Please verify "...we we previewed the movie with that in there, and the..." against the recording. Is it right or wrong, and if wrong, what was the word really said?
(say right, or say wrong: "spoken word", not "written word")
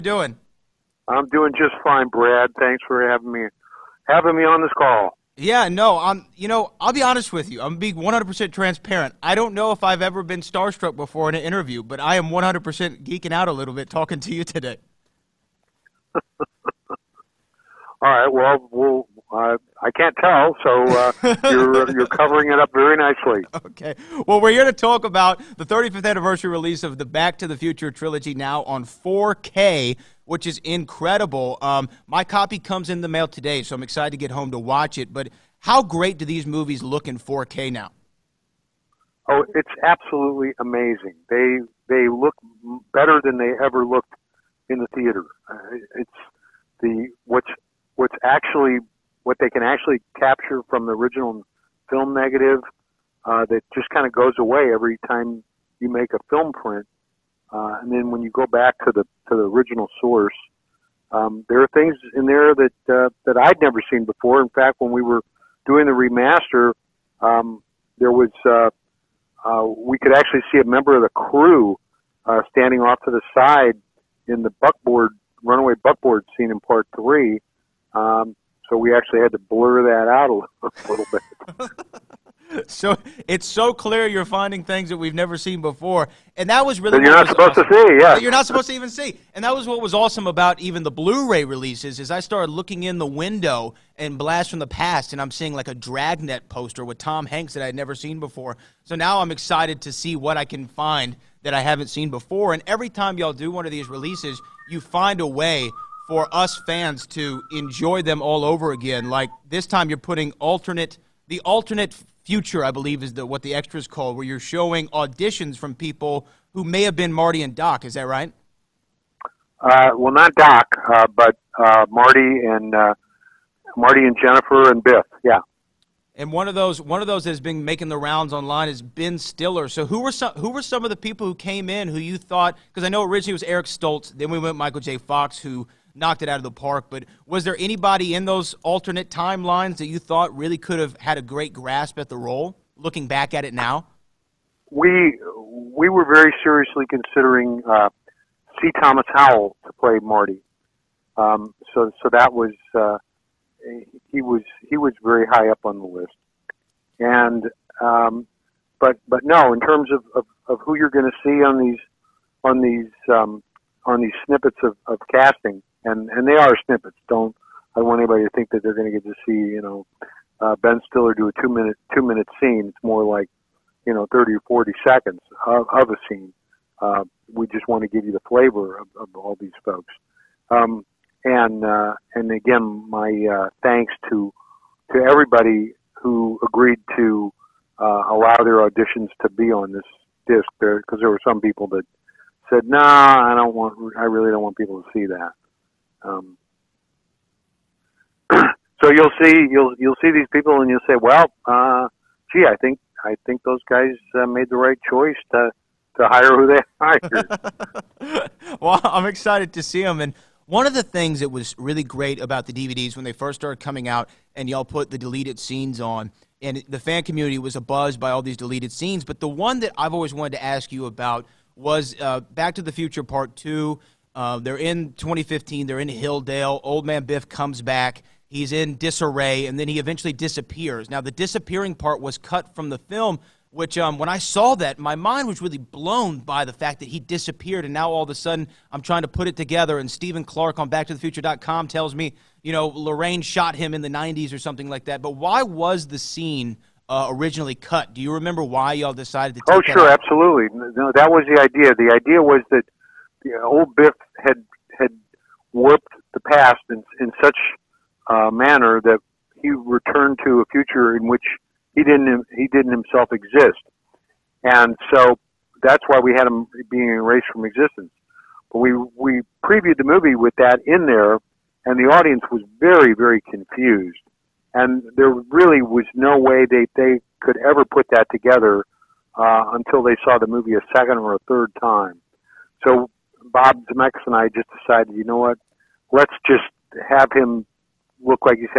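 right.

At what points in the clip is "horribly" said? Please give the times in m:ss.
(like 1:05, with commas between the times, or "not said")
not said.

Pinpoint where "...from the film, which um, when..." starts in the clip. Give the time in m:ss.
3:52.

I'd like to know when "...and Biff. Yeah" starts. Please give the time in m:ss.
2:04.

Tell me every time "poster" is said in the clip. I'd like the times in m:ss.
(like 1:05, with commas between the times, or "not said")
1:36.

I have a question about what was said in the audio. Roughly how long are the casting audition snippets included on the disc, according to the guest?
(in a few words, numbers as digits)
30 or 40 seconds.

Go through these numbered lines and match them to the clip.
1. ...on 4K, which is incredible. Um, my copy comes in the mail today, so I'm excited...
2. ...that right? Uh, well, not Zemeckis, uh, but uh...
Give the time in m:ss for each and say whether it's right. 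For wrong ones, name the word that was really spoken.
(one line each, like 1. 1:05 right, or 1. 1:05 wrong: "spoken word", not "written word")
1. 0:28 right
2. 1:57 wrong: "Doc", not "Zemeckis".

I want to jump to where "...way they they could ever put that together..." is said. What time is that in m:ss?
4:36.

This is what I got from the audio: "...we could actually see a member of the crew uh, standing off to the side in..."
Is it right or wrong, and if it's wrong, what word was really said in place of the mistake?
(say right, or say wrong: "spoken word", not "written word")
right.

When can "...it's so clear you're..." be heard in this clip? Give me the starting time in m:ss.
1:23.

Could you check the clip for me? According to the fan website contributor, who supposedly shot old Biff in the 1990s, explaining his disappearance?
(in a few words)
Lorraine.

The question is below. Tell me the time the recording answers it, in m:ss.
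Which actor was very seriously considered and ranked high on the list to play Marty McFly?
2:28.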